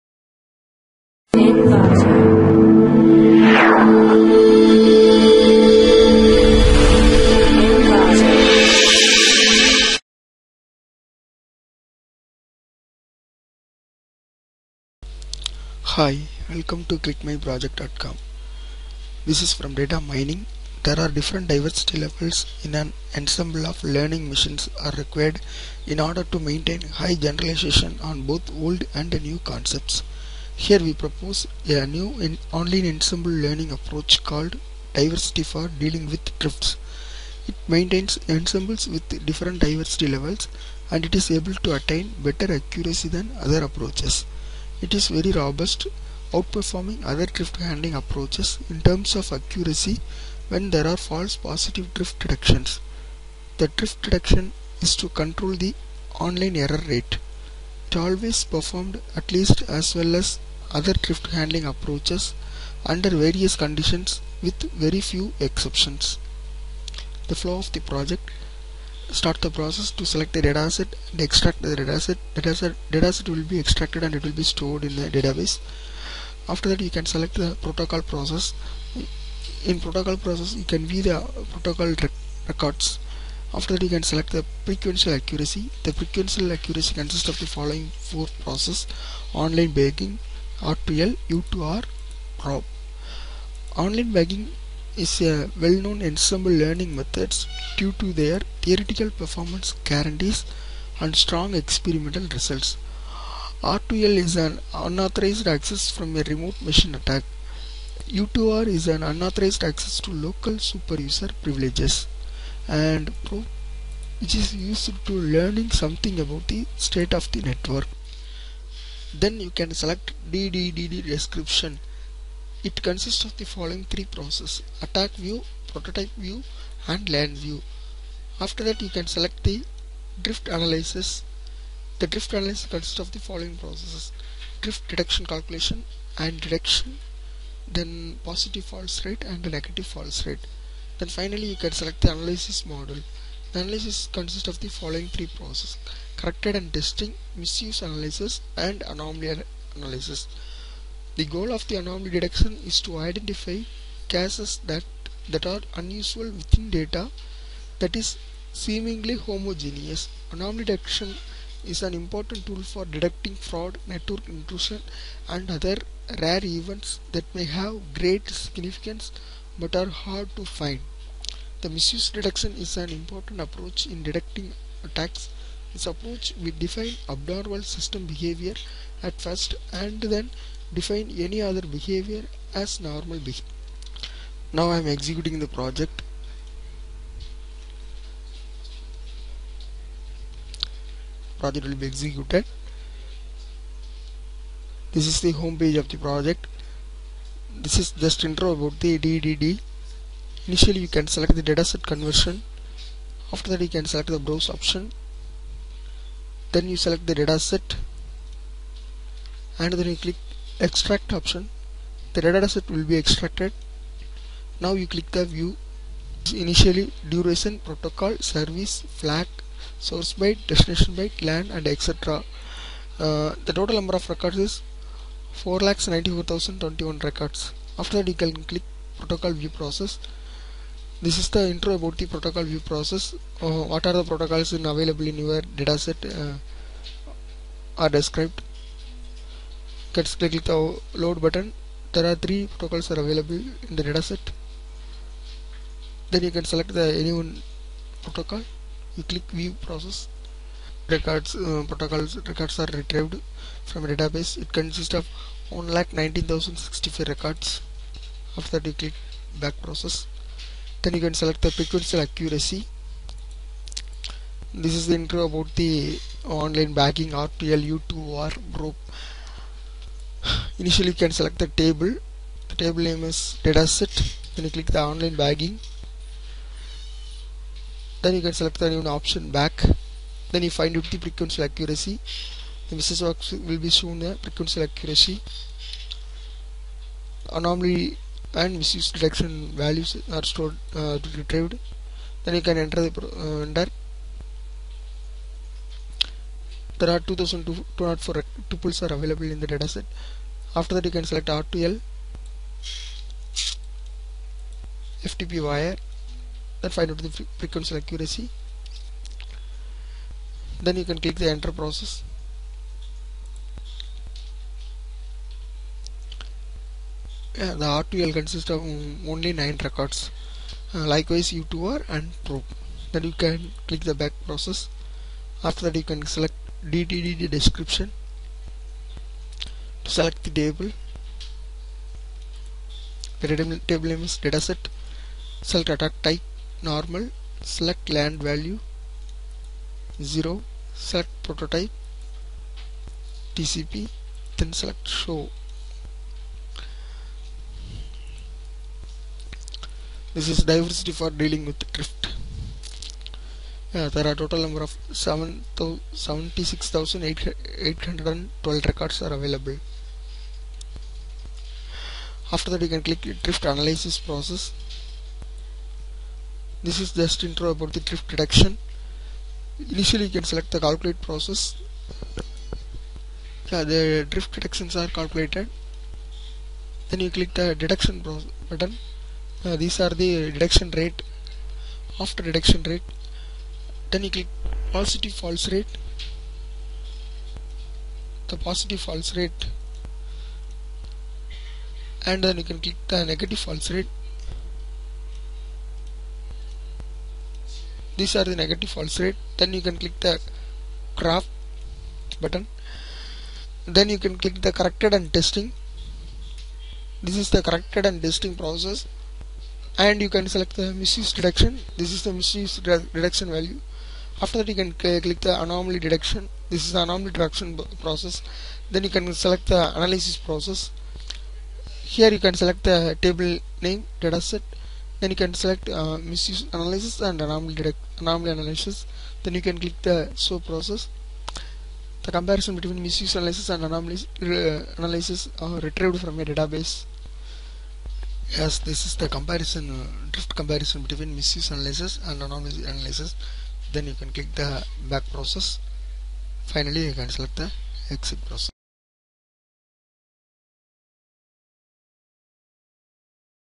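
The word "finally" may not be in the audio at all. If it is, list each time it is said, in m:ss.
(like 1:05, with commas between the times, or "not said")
2:21, 7:26.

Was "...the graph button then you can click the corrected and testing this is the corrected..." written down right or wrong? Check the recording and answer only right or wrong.
right.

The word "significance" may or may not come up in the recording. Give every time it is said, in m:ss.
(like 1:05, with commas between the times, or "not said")
2:48.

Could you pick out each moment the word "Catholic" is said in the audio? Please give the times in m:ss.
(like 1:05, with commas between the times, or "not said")
not said.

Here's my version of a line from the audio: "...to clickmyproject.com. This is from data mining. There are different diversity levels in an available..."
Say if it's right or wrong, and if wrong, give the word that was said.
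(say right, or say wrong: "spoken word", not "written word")
wrong: "ensemble", not "available".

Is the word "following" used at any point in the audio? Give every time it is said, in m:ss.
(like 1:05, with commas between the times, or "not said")
1:27, 2:03, 2:13, 2:24.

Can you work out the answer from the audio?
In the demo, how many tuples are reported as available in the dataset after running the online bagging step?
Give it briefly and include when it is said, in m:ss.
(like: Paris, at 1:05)
2204, at 4:56.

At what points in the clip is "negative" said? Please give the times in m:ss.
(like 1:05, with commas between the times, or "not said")
2:19, 6:33, 6:38.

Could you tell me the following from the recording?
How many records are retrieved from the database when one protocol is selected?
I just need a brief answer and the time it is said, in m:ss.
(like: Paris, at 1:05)
119,065, at 4:15.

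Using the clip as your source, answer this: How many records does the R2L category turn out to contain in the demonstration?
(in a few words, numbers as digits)
9.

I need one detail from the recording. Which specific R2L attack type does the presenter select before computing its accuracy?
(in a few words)
FTP write.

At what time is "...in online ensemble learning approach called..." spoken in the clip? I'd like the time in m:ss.
0:32.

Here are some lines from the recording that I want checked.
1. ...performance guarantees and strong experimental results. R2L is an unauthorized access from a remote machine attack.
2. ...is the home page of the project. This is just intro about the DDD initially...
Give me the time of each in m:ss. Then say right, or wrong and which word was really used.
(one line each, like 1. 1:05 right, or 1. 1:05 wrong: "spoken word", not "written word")
1. 1:39 right
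2. 3:15 right.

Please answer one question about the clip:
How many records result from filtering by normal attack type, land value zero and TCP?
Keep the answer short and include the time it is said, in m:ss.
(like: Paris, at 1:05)
76,812, at 5:54.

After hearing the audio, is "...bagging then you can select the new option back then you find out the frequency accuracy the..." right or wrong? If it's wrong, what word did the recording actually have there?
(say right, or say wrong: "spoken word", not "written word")
right.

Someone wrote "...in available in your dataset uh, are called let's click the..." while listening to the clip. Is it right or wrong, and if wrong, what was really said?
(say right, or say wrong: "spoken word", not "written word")
wrong: "described", not "called".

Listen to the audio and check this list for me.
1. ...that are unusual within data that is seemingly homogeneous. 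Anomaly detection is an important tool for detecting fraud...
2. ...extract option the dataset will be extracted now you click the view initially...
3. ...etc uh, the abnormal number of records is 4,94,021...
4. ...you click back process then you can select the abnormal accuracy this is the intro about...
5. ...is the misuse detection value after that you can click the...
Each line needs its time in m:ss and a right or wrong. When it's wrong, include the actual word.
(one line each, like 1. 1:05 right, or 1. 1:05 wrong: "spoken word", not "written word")
1. 2:35 right
2. 3:30 right
3. 3:41 wrong: "total", not "abnormal"
4. 4:18 wrong: "sequential", not "abnormal"
5. 6:51 right.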